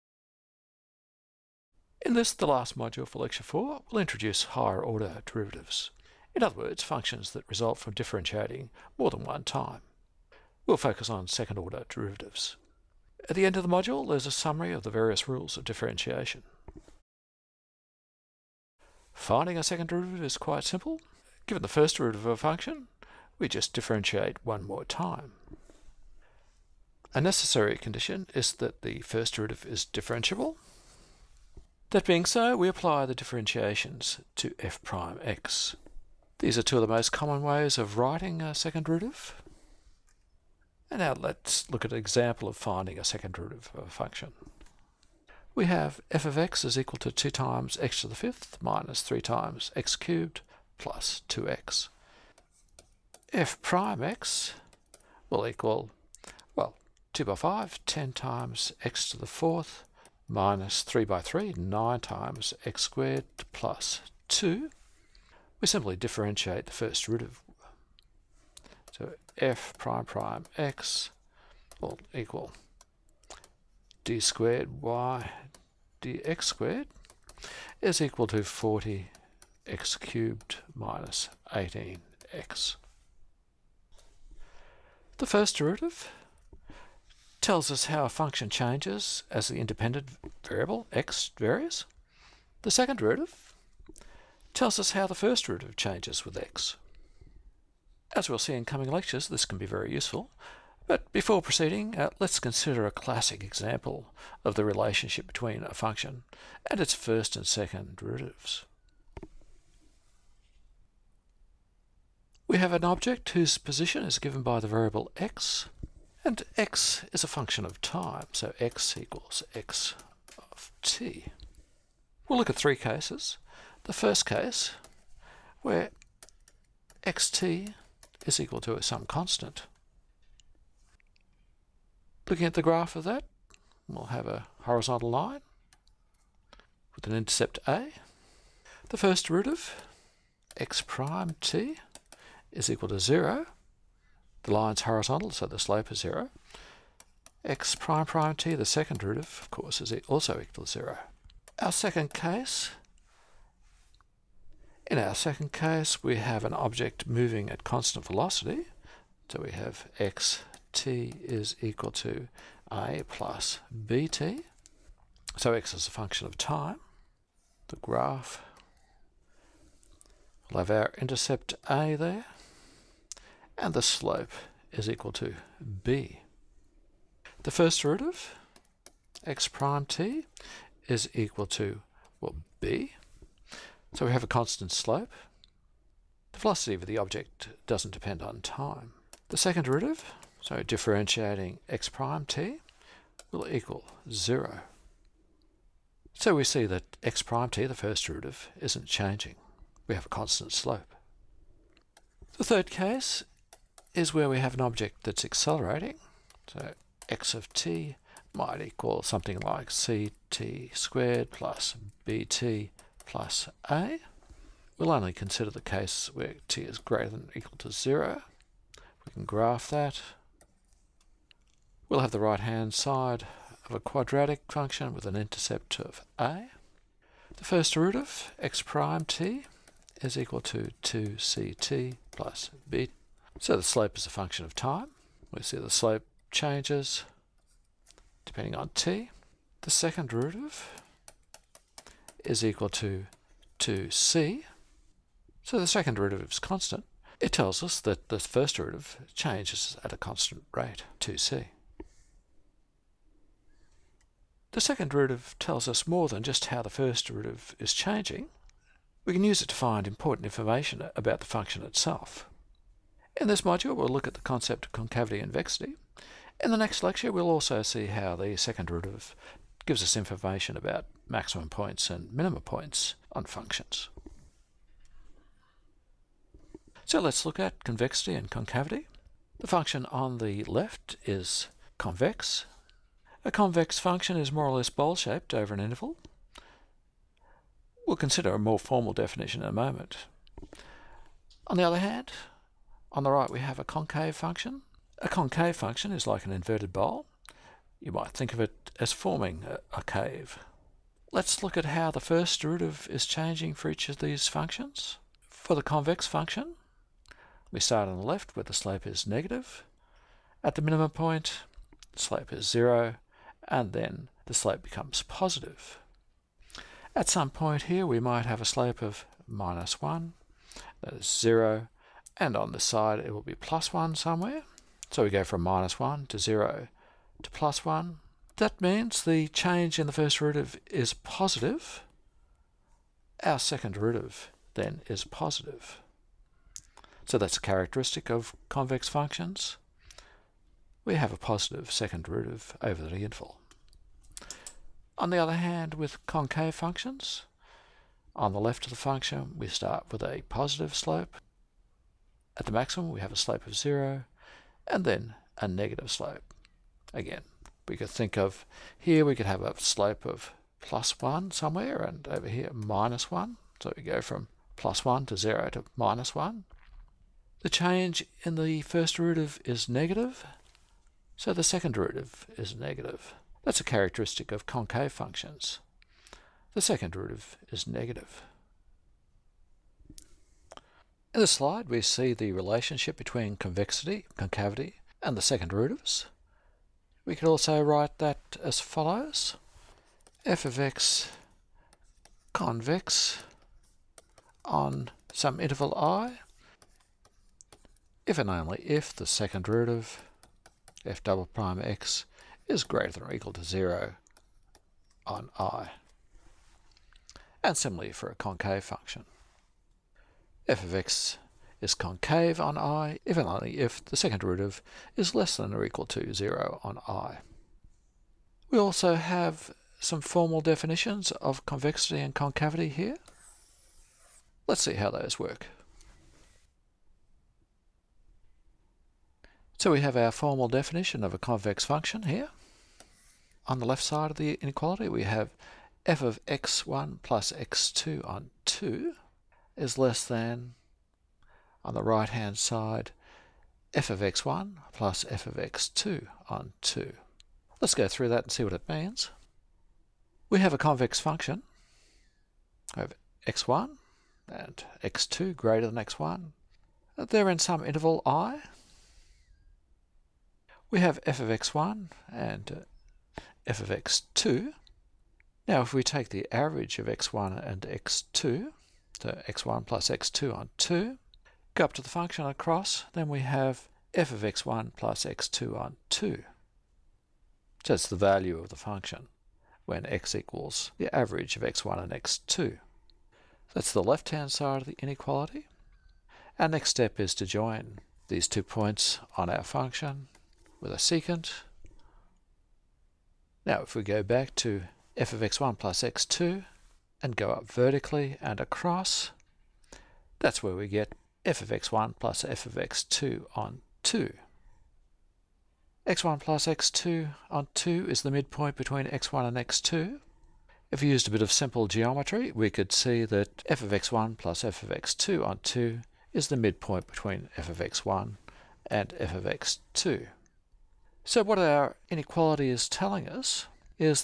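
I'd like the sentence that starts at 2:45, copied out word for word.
So x is a function of time.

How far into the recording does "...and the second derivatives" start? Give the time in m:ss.
6:25.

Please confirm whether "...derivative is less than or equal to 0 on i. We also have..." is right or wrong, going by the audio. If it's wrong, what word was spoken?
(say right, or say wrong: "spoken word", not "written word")
right.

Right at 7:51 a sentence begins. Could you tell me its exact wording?
Go up to the function across, then we have f of x1 plus x2 on 2.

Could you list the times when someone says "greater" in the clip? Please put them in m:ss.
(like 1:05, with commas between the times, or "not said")
3:36, 6:42, 7:35.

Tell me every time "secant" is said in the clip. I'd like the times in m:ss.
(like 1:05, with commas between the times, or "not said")
8:10.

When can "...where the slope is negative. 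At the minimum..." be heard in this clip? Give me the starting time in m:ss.
5:08.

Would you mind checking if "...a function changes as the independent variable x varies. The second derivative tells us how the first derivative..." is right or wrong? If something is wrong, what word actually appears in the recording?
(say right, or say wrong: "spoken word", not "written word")
right.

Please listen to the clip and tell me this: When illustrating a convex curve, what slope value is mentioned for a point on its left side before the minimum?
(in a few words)
-1.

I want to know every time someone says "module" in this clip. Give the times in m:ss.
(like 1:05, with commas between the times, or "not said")
0:02, 0:13, 4:23.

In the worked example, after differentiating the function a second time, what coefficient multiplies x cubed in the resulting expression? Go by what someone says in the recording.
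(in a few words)
40.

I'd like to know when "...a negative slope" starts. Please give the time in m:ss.
5:55.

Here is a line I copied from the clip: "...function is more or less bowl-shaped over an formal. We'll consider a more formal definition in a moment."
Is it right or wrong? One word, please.
wrong.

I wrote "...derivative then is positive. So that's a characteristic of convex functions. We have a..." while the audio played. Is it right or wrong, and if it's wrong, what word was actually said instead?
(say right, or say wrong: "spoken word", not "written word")
right.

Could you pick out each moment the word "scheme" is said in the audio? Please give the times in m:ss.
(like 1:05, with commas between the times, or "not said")
not said.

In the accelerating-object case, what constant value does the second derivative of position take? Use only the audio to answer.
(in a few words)
2c.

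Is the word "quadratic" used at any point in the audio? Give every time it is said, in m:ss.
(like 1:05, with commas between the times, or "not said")
3:43.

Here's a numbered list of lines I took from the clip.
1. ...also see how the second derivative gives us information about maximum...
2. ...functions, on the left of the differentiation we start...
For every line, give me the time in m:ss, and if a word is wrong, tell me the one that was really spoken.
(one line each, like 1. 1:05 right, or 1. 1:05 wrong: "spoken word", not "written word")
1. 4:27 right
2. 5:46 wrong: "function", not "differentiation".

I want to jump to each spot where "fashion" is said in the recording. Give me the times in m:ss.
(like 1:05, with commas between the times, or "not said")
not said.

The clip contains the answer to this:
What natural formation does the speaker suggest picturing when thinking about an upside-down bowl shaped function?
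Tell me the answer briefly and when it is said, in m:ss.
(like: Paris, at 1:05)
a cave, at 4:59.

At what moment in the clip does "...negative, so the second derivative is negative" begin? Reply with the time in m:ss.
6:09.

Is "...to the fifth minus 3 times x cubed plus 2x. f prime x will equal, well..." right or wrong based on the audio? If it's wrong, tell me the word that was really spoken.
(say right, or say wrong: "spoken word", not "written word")
right.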